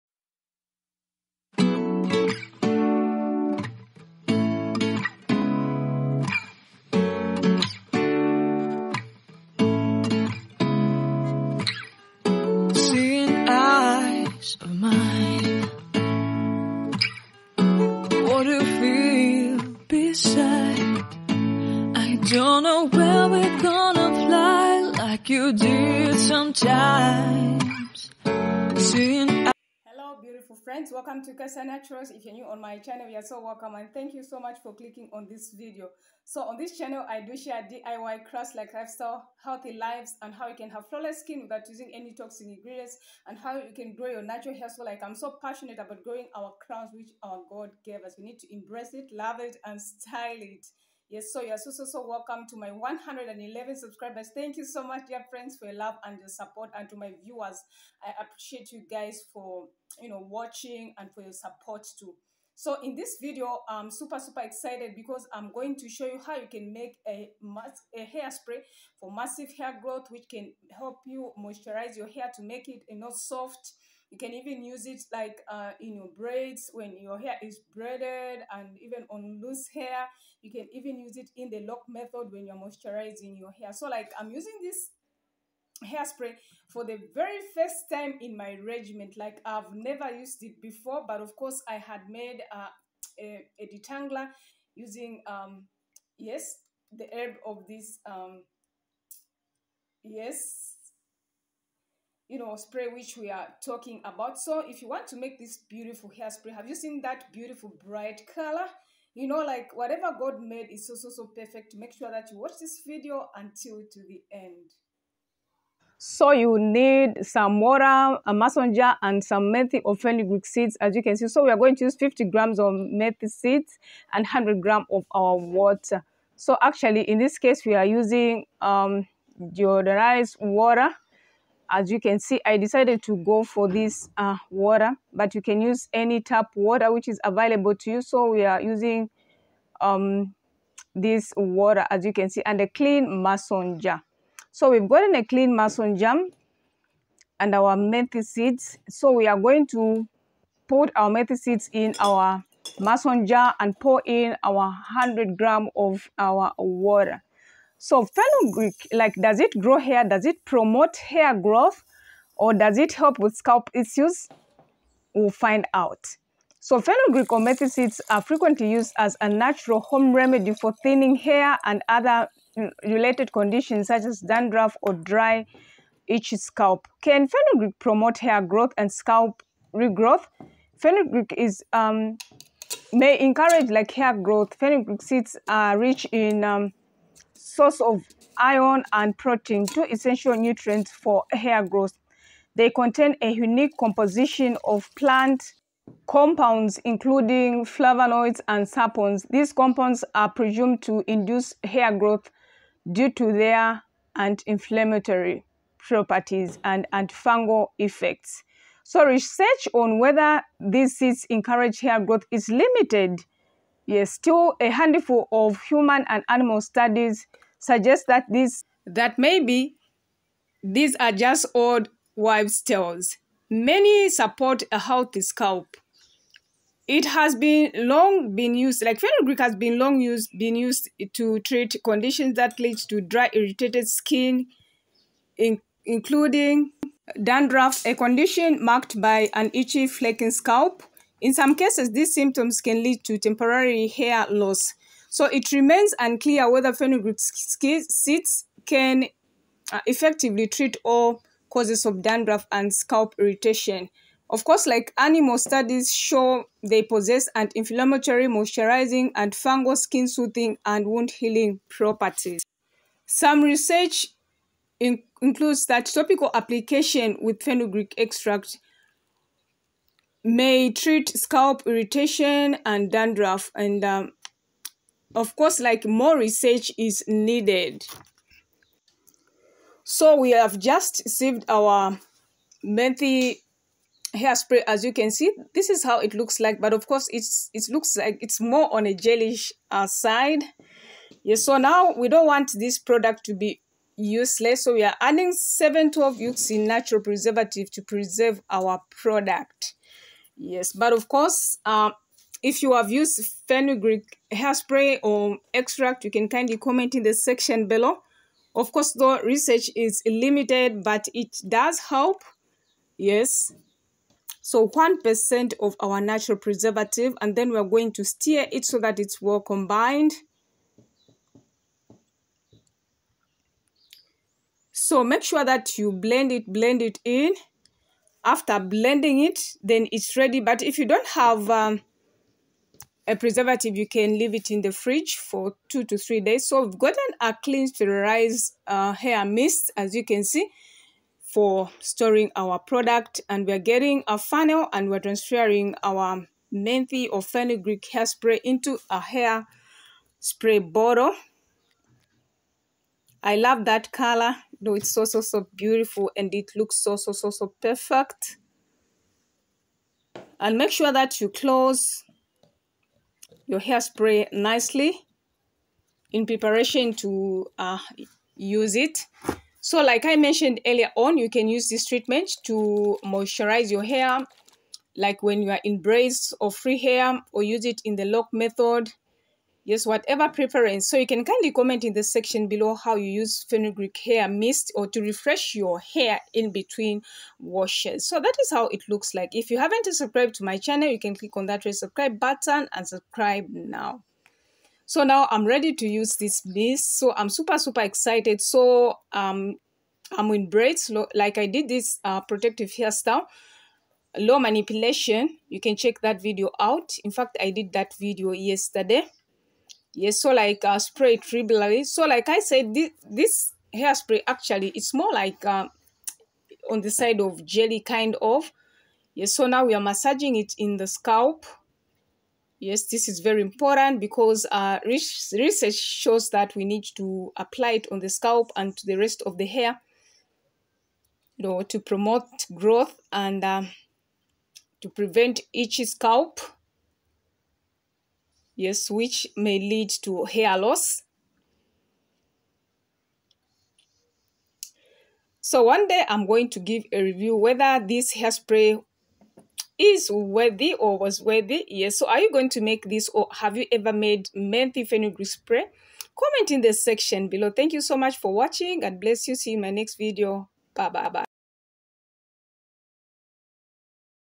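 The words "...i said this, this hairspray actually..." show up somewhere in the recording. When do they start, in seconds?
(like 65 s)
412 s.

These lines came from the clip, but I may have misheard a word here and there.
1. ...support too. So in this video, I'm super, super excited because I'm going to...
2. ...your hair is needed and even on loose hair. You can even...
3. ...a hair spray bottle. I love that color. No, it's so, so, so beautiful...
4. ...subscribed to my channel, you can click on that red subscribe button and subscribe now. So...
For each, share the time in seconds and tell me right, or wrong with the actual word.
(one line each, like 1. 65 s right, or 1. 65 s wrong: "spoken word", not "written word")
1. 61 s right
2. 77 s wrong: "braided", not "needed"
3. 348 s right
4. 389 s right.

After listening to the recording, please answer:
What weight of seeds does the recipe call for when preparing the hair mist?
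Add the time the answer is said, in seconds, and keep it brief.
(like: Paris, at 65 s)
50 grams, at 121 s.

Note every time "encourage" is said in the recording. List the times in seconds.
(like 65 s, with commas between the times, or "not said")
183 s, 211 s.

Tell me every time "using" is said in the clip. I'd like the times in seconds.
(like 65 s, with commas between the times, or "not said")
41 s, 84 s, 94 s, 127 s, 138 s.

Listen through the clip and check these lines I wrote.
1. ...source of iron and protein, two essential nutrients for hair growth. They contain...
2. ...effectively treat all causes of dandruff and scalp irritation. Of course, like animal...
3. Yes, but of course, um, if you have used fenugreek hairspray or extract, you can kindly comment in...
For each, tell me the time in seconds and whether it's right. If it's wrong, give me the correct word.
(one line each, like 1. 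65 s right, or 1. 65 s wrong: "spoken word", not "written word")
1. 187 s right
2. 249 s right
3. 300 s right.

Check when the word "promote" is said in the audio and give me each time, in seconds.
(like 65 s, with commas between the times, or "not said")
160 s, 177 s, 431 s.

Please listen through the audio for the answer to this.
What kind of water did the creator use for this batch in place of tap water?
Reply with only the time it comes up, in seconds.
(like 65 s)
129 s.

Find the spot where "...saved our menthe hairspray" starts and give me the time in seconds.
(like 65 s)
281 s.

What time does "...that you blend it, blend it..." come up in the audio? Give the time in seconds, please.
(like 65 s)
325 s.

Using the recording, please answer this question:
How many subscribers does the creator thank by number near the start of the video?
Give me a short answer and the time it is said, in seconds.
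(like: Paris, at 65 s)
111, at 52 s.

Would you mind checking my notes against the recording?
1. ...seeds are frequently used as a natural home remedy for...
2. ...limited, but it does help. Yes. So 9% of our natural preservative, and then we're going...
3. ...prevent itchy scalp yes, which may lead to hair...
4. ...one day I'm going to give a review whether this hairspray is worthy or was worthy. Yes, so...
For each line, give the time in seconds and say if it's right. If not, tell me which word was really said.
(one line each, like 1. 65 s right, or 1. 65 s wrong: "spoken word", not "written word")
1. 167 s right
2. 310 s wrong: "1", not "9"
3. 434 s right
4. 445 s right.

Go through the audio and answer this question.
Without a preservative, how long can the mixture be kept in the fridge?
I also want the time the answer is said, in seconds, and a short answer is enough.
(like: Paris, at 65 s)
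2 to 3 days, at 335 s.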